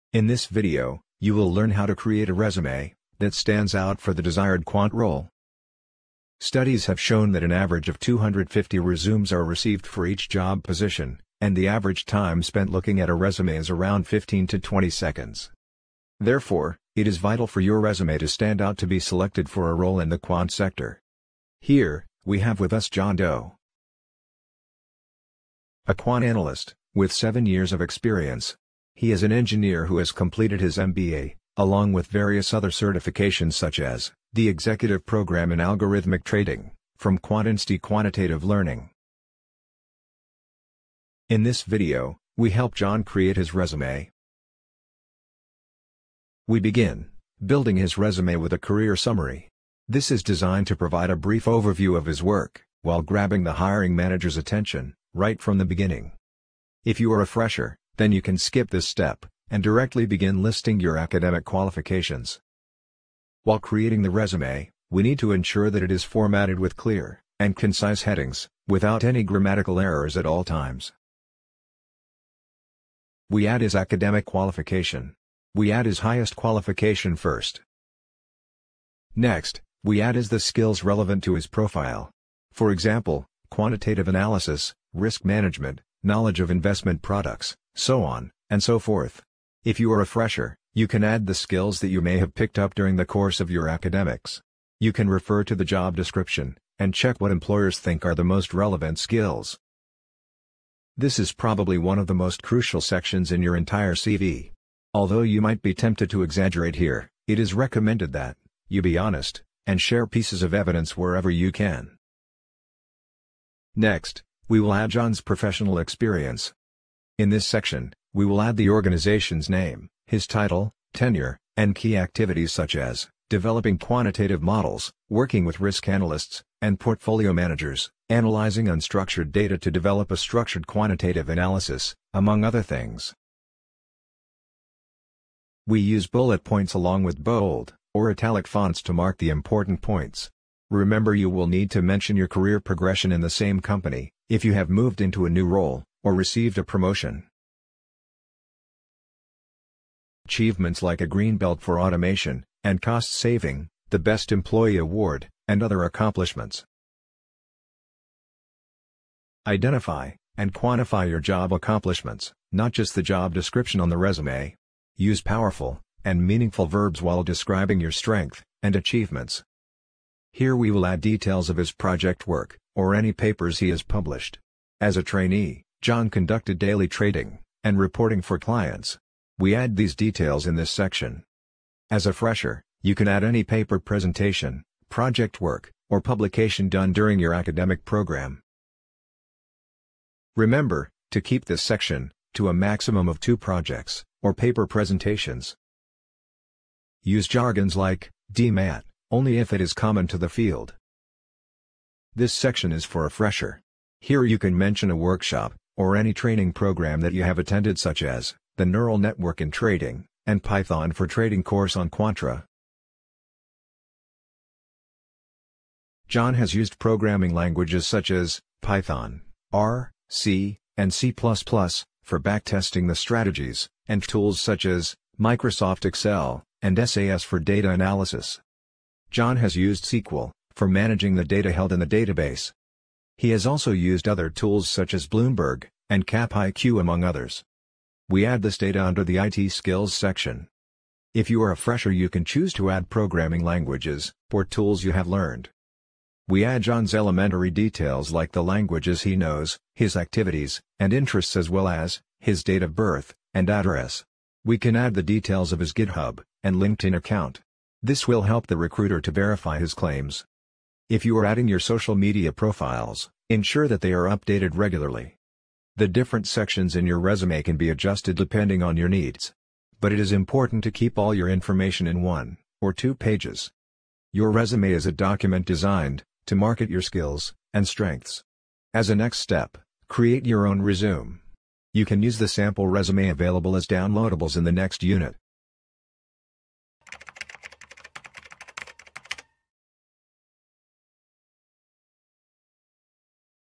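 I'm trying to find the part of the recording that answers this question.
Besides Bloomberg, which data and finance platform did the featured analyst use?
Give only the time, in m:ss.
3:56.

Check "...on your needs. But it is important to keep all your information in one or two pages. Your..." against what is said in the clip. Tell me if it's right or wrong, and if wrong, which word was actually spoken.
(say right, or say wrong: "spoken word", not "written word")
right.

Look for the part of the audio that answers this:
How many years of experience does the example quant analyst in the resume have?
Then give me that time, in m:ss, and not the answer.
0:27.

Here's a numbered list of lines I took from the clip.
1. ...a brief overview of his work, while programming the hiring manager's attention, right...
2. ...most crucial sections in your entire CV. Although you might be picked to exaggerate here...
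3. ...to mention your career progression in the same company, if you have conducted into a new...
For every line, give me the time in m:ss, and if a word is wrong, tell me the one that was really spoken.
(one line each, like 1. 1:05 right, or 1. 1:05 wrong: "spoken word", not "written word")
1. 0:51 wrong: "grabbing", not "programming"
2. 1:42 wrong: "tempted", not "picked"
3. 2:21 wrong: "moved", not "conducted".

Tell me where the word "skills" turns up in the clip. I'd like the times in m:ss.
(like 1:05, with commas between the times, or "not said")
1:20, 1:31, 1:38, 3:59, 4:36.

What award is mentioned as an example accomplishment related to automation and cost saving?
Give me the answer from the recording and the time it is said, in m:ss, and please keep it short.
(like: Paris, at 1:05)
green belt, at 2:31.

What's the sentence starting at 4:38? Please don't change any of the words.
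As a next step, create your own resume.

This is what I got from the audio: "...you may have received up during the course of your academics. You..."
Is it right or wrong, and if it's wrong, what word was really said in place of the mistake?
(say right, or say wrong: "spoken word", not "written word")
wrong: "picked", not "received".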